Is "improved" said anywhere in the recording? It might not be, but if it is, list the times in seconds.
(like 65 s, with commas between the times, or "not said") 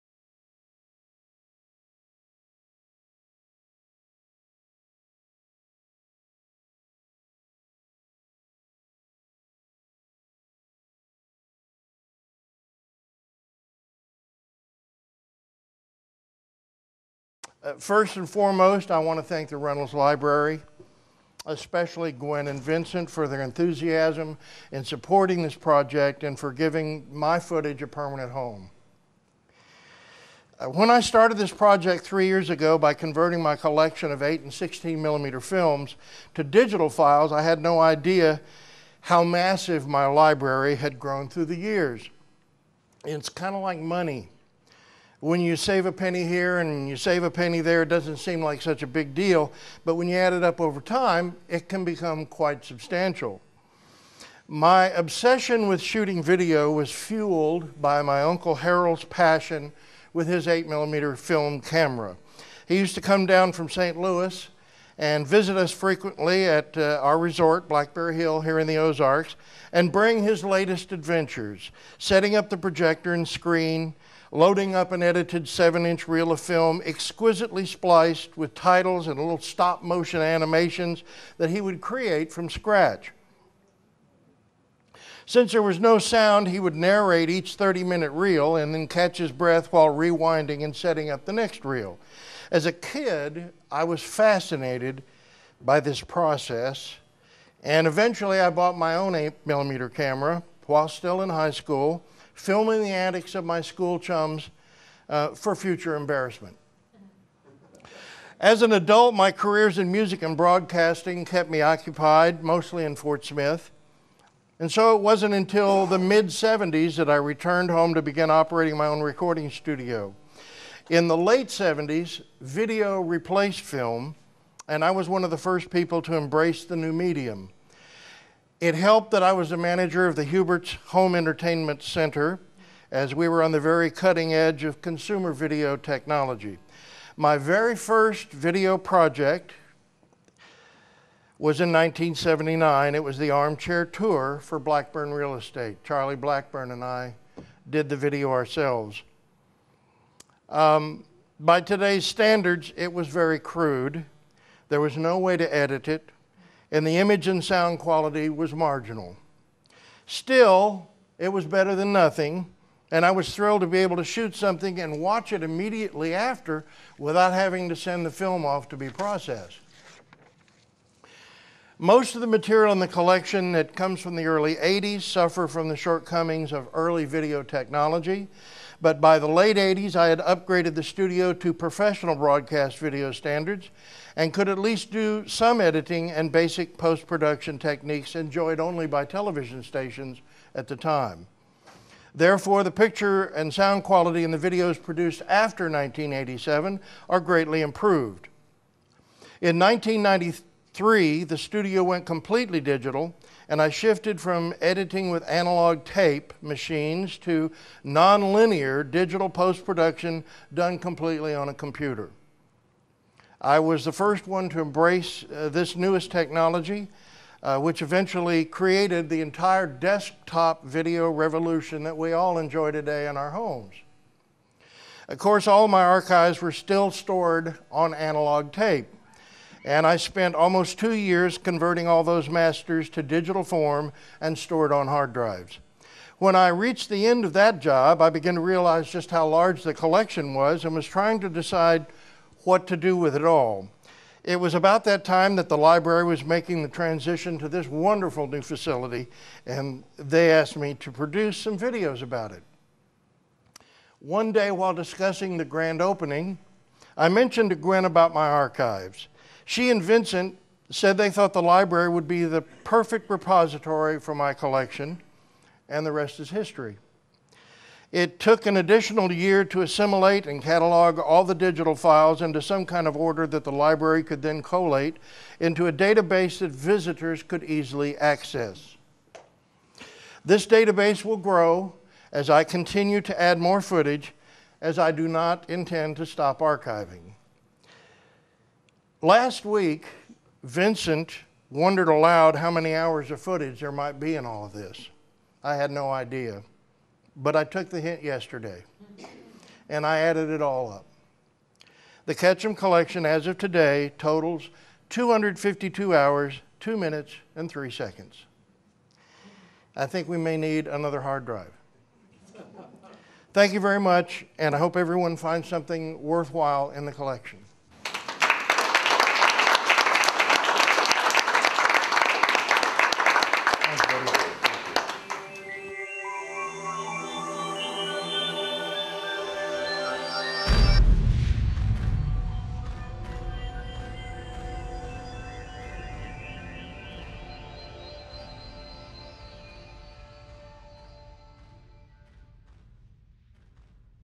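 197 s.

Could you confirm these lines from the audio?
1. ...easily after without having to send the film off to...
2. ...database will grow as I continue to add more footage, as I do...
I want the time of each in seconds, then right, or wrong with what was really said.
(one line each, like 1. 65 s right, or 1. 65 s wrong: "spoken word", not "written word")
1. 165 s wrong: "immediately", not "easily"
2. 280 s right.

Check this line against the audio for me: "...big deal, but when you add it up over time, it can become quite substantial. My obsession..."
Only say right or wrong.
right.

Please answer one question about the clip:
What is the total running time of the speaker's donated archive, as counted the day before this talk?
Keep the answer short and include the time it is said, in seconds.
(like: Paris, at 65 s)
252 hours, 2 minutes, 3 seconds, at 304 s.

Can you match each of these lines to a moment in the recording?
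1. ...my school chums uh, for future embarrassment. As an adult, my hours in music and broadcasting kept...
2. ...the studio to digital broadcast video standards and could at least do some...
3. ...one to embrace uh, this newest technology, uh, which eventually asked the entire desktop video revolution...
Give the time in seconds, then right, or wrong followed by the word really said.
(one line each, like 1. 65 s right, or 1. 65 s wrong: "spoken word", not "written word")
1. 103 s wrong: "careers", not "hours"
2. 180 s wrong: "professional", not "digital"
3. 214 s wrong: "created", not "asked".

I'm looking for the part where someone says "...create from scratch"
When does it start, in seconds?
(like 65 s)
81 s.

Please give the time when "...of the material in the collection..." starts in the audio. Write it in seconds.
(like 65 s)
172 s.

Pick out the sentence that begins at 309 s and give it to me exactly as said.
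I think we may need another hard drive.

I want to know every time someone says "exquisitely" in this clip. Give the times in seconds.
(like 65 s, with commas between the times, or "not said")
76 s.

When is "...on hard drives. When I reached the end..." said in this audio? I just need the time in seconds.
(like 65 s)
234 s.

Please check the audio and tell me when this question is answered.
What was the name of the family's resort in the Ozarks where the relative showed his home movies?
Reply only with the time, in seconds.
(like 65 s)
67 s.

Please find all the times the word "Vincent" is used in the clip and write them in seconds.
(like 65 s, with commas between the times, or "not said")
22 s, 259 s, 290 s.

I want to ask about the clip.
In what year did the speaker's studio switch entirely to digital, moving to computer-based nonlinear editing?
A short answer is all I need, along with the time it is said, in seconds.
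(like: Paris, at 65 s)
1993, at 199 s.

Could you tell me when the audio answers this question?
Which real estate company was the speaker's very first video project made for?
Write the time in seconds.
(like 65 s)
144 s.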